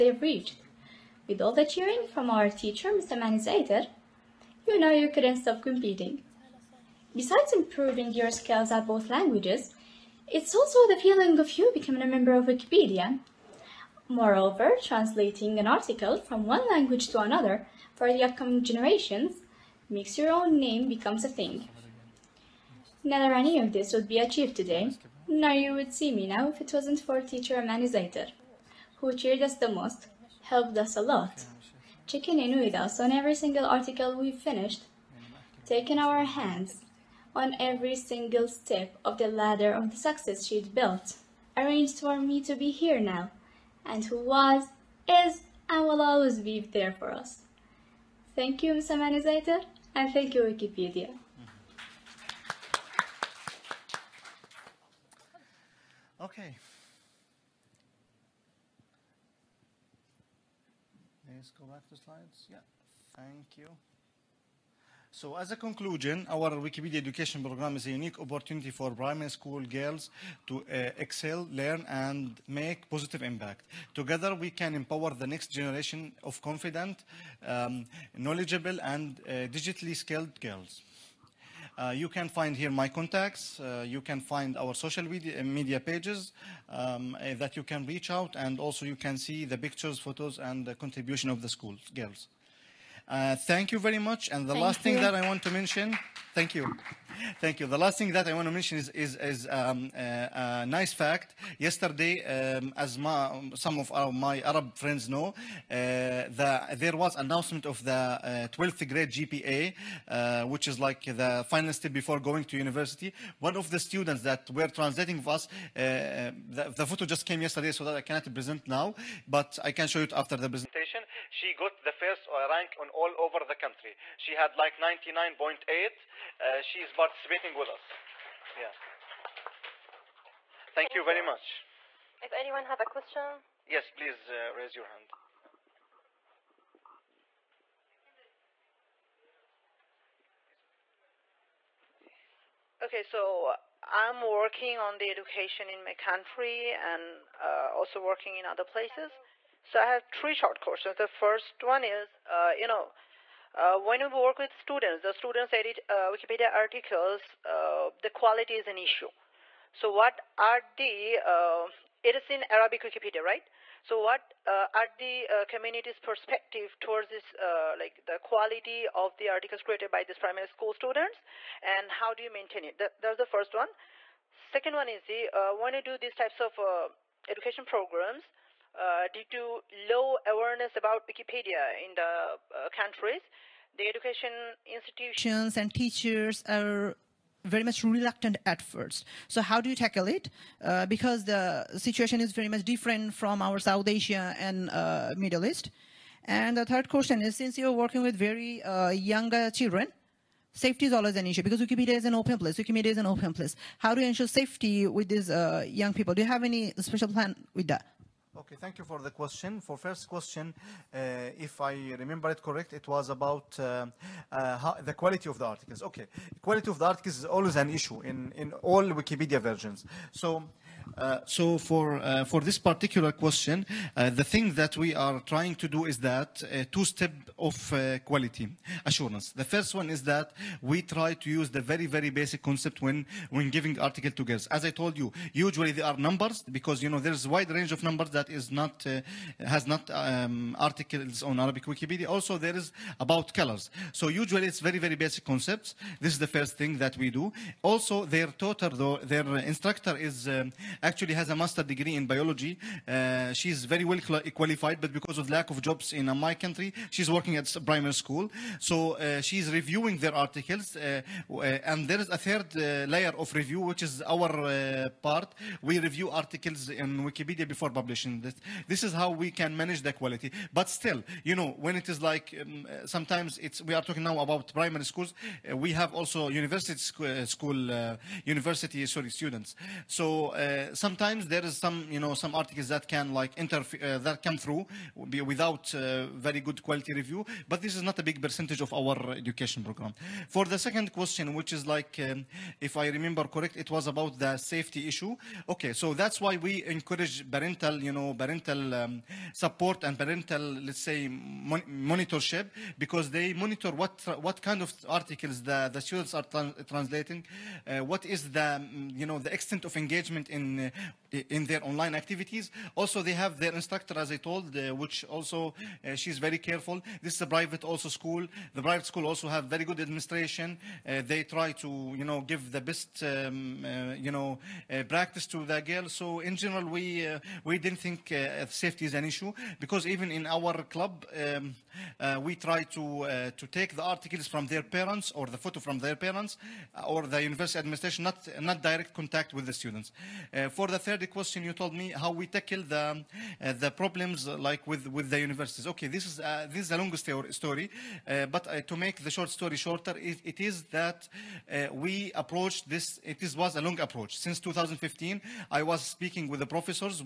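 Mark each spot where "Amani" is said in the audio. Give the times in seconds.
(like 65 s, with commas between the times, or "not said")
27 s, 48 s.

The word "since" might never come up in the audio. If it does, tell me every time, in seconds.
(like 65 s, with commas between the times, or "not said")
197 s, 354 s.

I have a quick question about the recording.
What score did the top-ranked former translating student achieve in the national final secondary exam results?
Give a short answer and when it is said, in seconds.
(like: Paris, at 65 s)
99.8, at 124 s.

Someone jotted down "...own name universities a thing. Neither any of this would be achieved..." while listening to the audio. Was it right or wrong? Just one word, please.
wrong.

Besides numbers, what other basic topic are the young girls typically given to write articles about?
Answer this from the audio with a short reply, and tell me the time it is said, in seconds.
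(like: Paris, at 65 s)
Colors, at 243 s.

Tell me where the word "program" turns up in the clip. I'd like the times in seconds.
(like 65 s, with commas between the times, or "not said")
67 s, 177 s, 289 s.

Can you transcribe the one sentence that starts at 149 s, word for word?
So I have three short questions.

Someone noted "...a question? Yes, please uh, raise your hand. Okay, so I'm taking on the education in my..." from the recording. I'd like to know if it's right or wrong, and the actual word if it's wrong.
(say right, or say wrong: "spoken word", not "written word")
wrong: "working", not "taking".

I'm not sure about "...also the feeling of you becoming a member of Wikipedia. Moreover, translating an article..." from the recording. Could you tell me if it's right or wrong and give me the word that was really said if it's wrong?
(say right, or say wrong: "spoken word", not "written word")
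right.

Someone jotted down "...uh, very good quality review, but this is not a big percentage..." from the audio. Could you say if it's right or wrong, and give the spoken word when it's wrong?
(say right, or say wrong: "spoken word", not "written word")
right.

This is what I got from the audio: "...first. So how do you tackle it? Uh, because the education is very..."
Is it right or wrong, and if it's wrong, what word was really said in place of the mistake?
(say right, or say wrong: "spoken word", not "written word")
wrong: "situation", not "education".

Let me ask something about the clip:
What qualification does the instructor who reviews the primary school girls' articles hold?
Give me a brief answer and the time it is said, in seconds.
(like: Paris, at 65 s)
Master's degree in biology, at 251 s.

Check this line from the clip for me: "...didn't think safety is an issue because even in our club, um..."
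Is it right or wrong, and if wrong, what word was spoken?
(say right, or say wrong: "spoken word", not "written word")
right.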